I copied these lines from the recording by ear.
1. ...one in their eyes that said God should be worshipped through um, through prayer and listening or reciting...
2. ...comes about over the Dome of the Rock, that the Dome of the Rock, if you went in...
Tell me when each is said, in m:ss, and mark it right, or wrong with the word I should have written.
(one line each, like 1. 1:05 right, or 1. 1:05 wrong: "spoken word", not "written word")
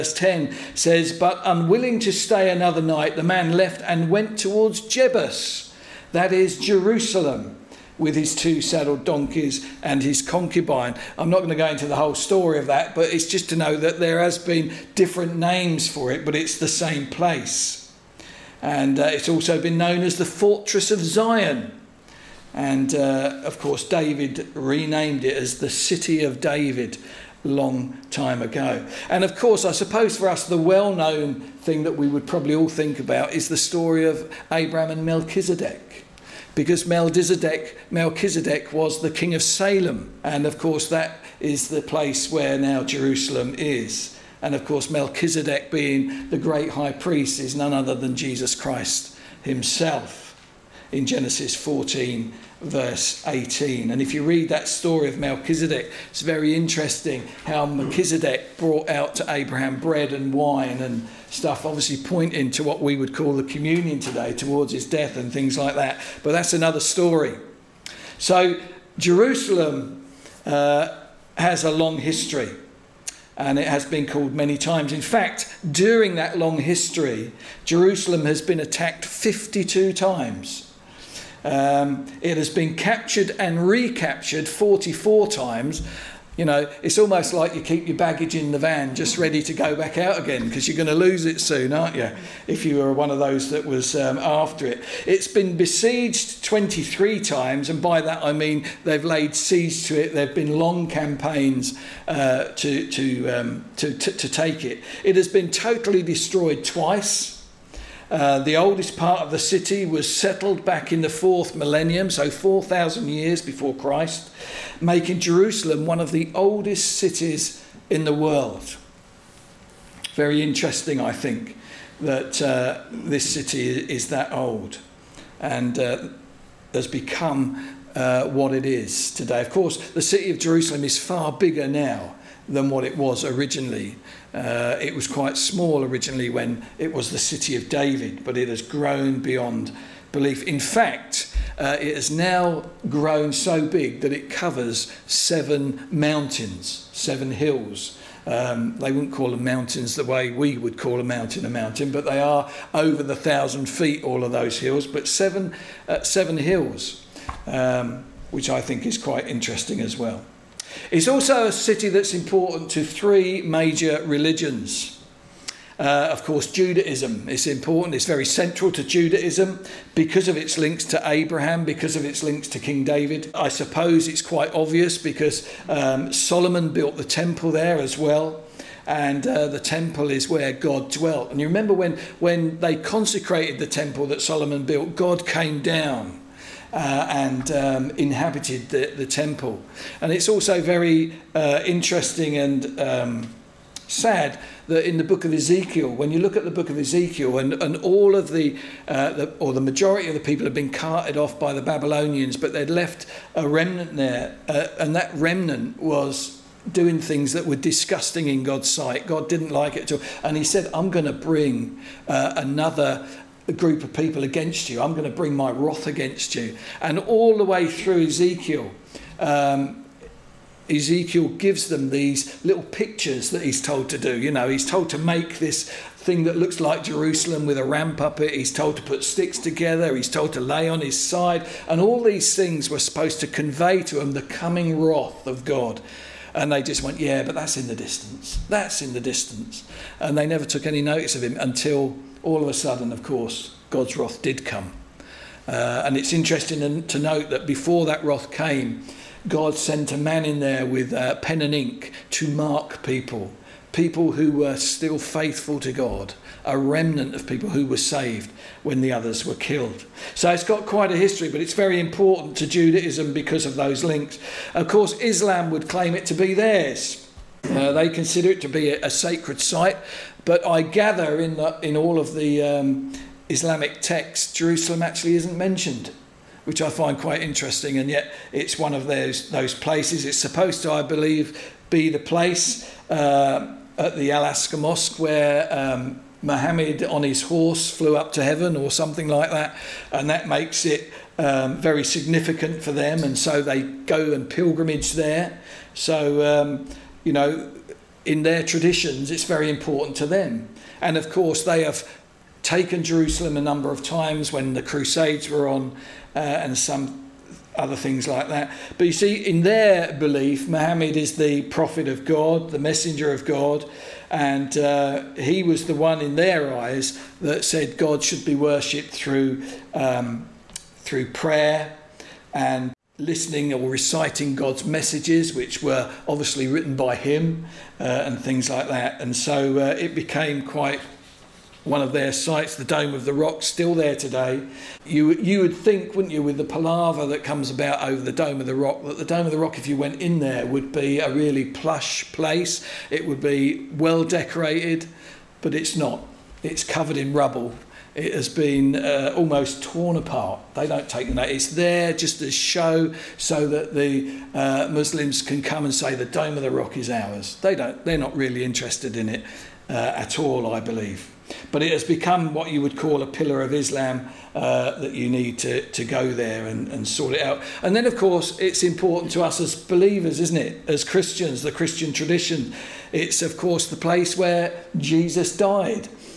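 1. 5:15 right
2. 5:37 right.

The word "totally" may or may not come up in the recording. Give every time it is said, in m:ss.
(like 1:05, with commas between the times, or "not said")
1:45.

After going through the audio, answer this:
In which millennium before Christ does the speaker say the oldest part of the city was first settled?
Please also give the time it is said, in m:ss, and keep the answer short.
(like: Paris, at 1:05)
fourth millennium, at 1:51.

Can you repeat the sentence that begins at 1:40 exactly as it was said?
There have been long campaigns uh, to, to, um, to, to, to take it.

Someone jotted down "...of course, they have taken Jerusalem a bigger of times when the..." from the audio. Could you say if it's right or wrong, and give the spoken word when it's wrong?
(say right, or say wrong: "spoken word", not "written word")
wrong: "number", not "bigger".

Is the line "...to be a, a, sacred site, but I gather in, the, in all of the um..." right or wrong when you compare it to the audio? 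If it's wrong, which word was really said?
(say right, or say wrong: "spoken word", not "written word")
right.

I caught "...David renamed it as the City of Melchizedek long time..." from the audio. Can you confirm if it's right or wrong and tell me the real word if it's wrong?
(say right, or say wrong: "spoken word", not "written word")
wrong: "David", not "Melchizedek".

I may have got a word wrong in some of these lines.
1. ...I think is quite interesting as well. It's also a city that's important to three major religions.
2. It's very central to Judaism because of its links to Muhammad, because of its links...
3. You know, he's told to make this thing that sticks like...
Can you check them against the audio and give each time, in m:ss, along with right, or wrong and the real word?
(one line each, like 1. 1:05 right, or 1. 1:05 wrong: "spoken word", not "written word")
1. 2:38 right
2. 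2:47 wrong: "Abraham", not "Muhammad"
3. 3:44 wrong: "looks", not "sticks".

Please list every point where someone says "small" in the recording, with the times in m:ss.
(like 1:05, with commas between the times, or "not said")
2:15.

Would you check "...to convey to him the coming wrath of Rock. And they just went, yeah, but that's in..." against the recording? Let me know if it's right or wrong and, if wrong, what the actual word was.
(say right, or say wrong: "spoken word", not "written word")
wrong: "God", not "Rock".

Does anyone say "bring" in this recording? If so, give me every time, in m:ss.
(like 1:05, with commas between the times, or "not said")
3:31, 3:35.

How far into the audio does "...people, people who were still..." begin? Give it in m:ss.
4:12.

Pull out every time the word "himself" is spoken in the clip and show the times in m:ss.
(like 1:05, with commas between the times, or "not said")
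0:49.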